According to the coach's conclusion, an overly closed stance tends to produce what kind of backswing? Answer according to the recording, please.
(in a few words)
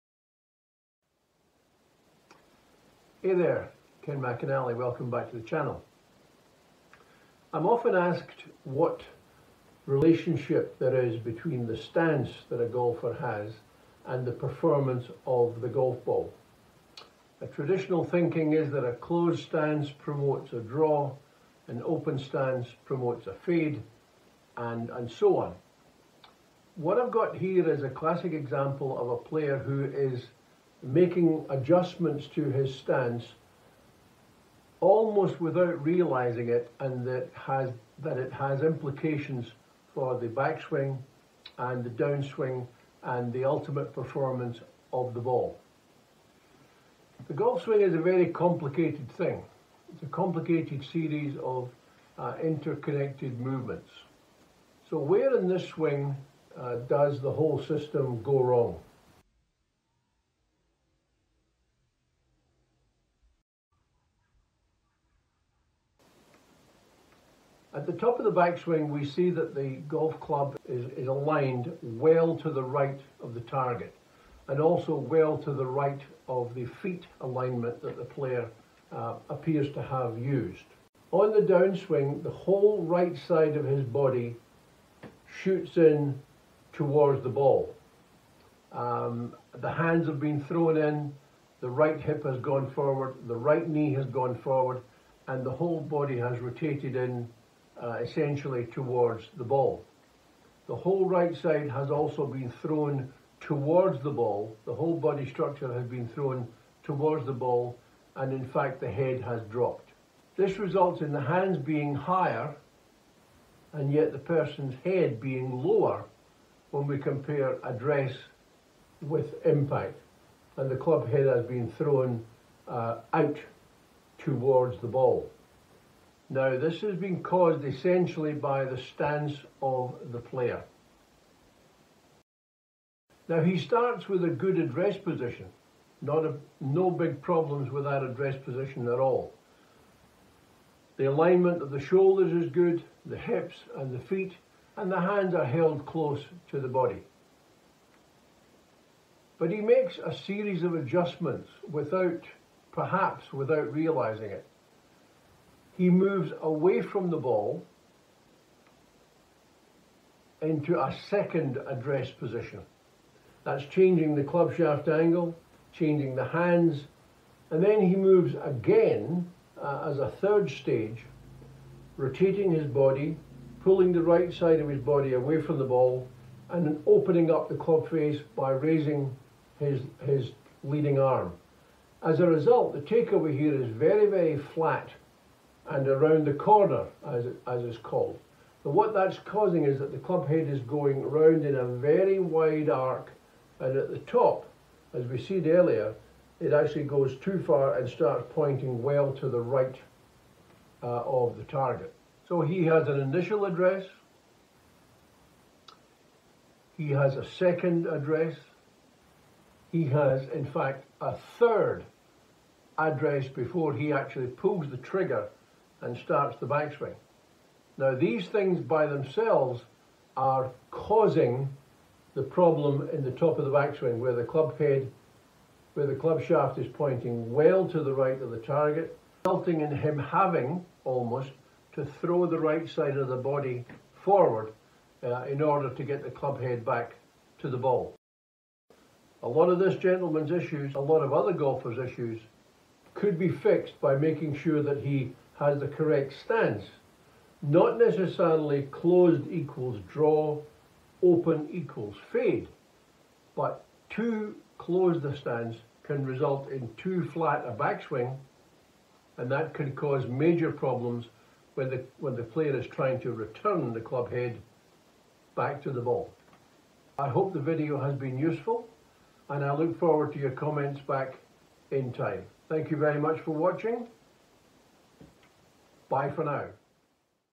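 too flat.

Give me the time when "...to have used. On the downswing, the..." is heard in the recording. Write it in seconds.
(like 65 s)
79 s.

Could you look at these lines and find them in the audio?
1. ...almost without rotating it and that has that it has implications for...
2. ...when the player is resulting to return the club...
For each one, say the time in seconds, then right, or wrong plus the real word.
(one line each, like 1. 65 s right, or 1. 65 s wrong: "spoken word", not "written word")
1. 34 s wrong: "realizing", not "rotating"
2. 261 s wrong: "trying", not "resulting".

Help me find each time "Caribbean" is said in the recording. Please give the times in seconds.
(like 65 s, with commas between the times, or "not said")
not said.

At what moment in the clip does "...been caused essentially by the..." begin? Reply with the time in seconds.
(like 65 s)
126 s.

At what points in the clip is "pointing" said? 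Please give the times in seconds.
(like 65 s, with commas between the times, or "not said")
198 s, 226 s.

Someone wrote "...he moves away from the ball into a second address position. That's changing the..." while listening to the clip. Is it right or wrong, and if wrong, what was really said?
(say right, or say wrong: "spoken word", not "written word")
right.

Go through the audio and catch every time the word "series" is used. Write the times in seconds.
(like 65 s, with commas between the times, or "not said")
50 s, 150 s.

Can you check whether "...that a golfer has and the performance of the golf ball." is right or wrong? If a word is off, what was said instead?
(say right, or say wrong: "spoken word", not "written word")
right.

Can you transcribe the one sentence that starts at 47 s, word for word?
The golf swing is a very complicated thing.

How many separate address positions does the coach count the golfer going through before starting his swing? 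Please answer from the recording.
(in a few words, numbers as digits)
3.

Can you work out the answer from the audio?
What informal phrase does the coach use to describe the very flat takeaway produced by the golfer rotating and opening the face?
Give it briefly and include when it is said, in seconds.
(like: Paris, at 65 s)
around the corner, at 185 s.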